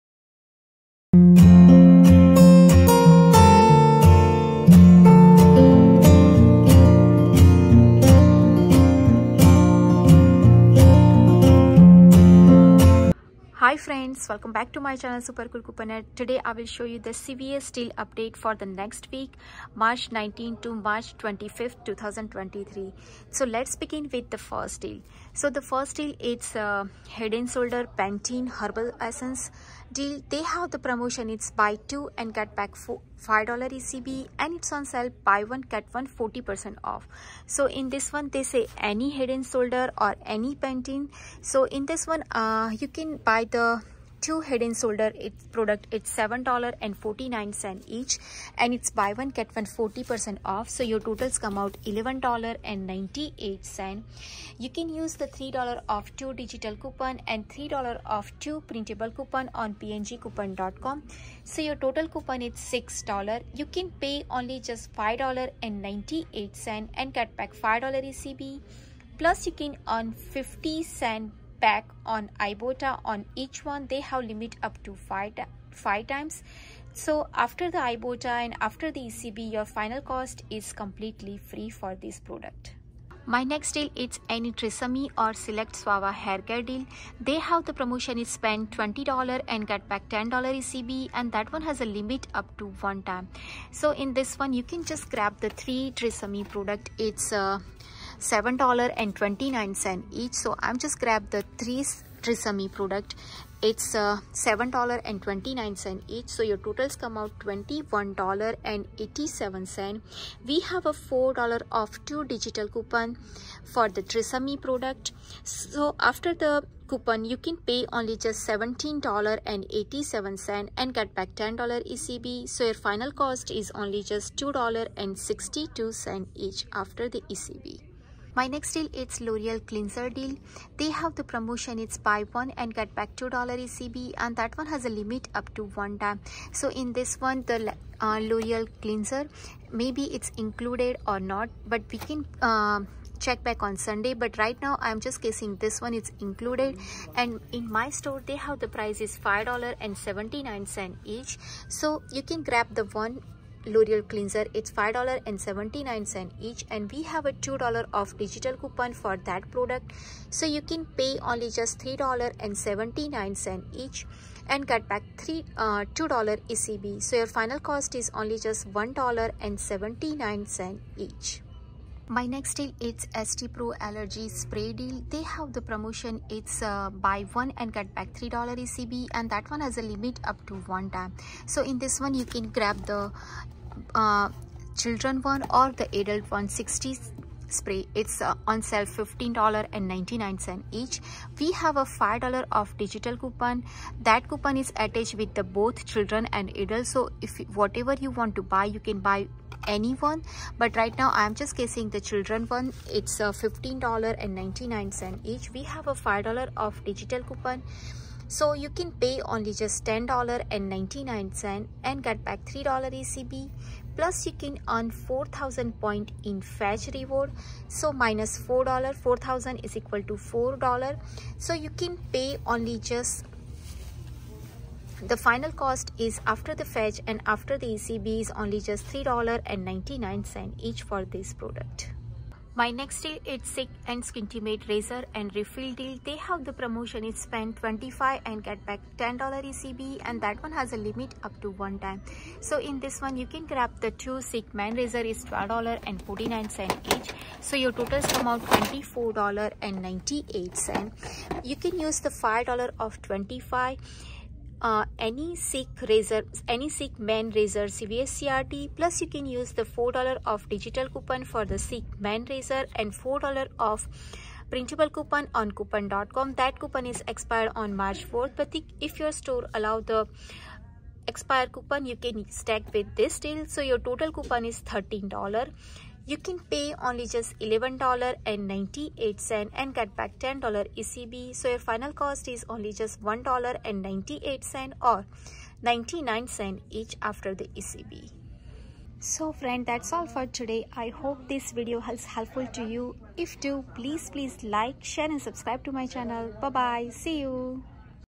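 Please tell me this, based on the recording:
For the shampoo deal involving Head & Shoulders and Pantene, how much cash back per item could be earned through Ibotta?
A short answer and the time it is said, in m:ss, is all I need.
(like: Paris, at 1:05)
50 cents, at 1:10.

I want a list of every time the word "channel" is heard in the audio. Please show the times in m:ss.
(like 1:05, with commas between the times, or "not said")
0:14, 4:55.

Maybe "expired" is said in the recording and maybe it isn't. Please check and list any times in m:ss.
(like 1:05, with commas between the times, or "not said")
4:27, 4:31.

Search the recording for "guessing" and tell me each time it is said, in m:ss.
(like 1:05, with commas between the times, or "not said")
2:25, 3:21.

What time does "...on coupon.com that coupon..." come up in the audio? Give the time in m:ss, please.
4:25.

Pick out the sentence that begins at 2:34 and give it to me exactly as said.
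It's $5.79 each and we have a $2 off digital coupon for that product.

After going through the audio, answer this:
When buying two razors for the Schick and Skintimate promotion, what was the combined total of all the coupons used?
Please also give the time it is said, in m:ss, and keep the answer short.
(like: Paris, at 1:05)
$13, at 4:34.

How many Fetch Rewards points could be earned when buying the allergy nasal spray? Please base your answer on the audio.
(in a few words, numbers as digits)
4000.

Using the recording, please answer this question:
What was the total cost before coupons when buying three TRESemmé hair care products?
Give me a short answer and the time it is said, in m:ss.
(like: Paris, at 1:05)
$21.87, at 1:47.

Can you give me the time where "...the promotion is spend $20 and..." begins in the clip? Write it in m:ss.
1:27.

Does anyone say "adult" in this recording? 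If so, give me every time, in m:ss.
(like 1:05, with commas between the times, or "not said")
3:06, 3:16.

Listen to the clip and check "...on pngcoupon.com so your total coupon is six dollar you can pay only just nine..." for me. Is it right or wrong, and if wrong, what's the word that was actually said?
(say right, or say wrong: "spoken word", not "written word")
wrong: "five", not "nine".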